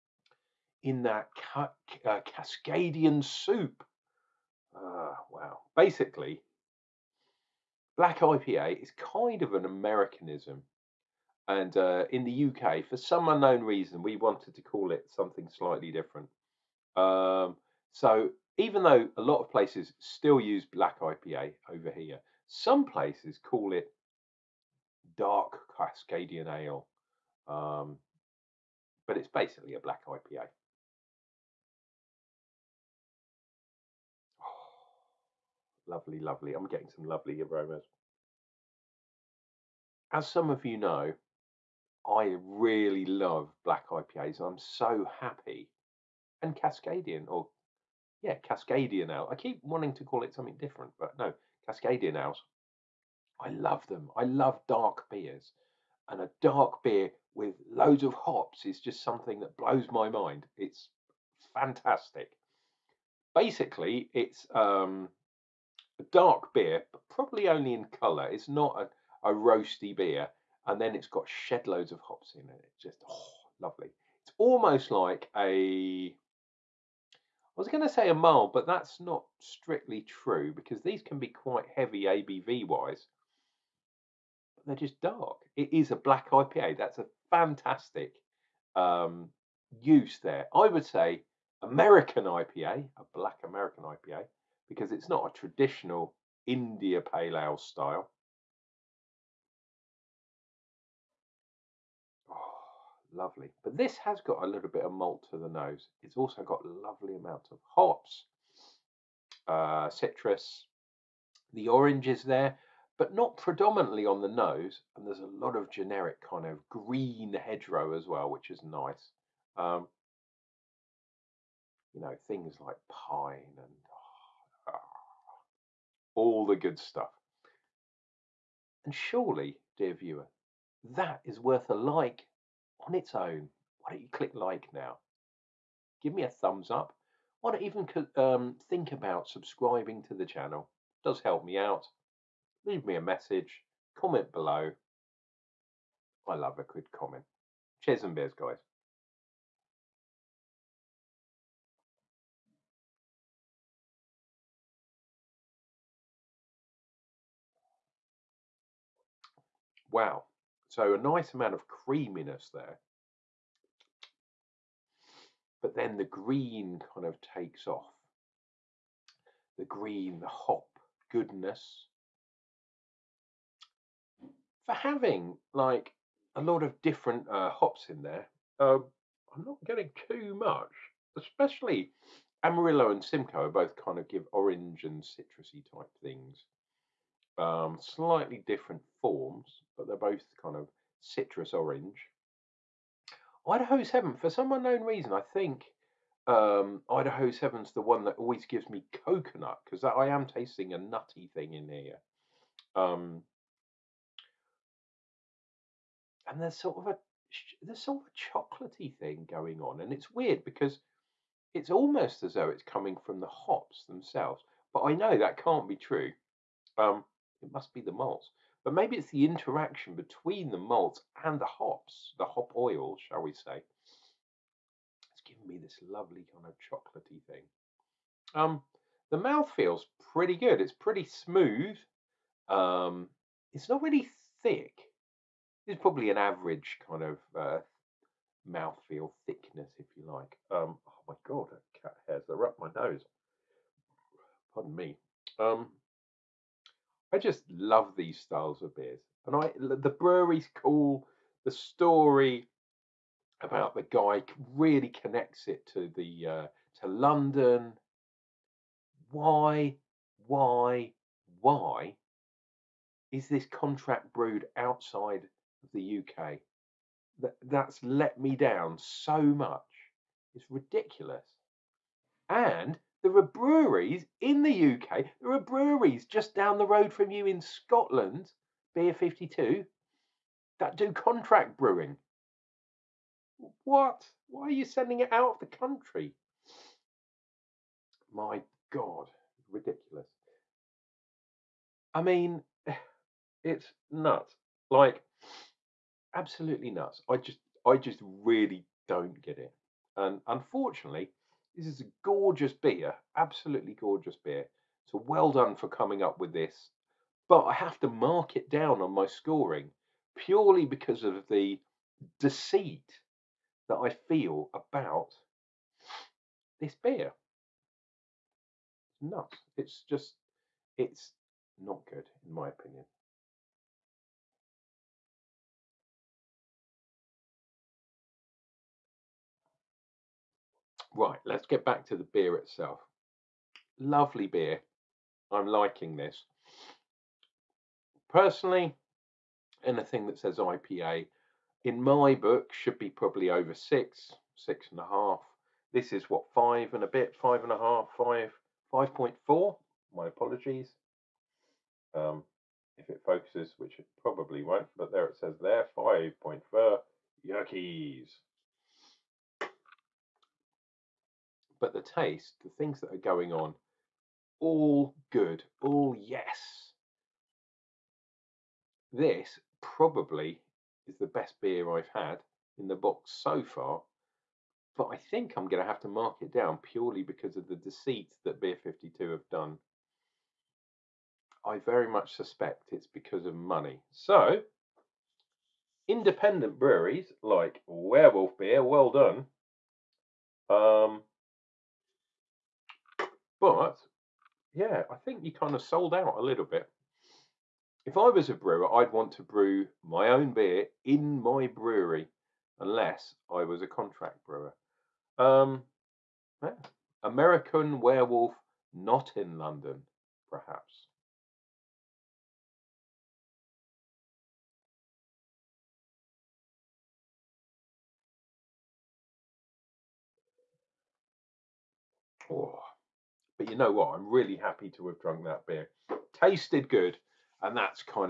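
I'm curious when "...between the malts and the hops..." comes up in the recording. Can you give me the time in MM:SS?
03:39.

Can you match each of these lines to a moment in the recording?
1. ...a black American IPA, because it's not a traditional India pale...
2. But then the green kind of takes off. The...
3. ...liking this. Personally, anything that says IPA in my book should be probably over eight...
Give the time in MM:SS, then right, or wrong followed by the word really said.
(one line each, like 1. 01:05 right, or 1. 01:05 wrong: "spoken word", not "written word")
1. 01:32 right
2. 02:45 right
3. 05:35 wrong: "six", not "eight".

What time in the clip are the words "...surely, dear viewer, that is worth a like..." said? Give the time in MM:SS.
02:08.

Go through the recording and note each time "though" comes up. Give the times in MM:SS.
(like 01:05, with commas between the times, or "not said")
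00:18, 03:32.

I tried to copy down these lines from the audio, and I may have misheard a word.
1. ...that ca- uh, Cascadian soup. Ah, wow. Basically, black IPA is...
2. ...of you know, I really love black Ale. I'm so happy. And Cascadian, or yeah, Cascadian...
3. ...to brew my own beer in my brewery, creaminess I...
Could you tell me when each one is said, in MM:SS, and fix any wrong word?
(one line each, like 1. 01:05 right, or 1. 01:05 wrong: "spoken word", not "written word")
1. 00:01 right
2. 00:40 wrong: "IPAs", not "Ale"
3. 06:39 wrong: "unless", not "creaminess".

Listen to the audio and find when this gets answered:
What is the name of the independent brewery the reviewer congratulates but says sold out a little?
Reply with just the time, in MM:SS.
06:27.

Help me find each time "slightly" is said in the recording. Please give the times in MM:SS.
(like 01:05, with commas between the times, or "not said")
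00:15, 03:07.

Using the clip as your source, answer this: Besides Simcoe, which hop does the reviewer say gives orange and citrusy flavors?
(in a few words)
Amarillo.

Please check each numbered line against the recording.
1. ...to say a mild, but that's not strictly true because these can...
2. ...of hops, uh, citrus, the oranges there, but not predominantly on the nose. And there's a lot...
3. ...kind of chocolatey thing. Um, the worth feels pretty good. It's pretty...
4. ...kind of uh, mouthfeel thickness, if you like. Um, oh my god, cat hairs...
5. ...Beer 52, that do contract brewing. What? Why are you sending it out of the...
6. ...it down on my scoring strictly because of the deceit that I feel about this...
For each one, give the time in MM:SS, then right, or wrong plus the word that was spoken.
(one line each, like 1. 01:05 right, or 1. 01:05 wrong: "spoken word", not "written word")
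1. 01:17 right
2. 01:47 right
3. 03:46 wrong: "mouth", not "worth"
4. 03:56 right
5. 04:38 right
6. 05:08 wrong: "purely", not "strictly".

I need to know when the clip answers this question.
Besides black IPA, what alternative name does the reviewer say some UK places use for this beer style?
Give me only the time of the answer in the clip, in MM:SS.
00:25.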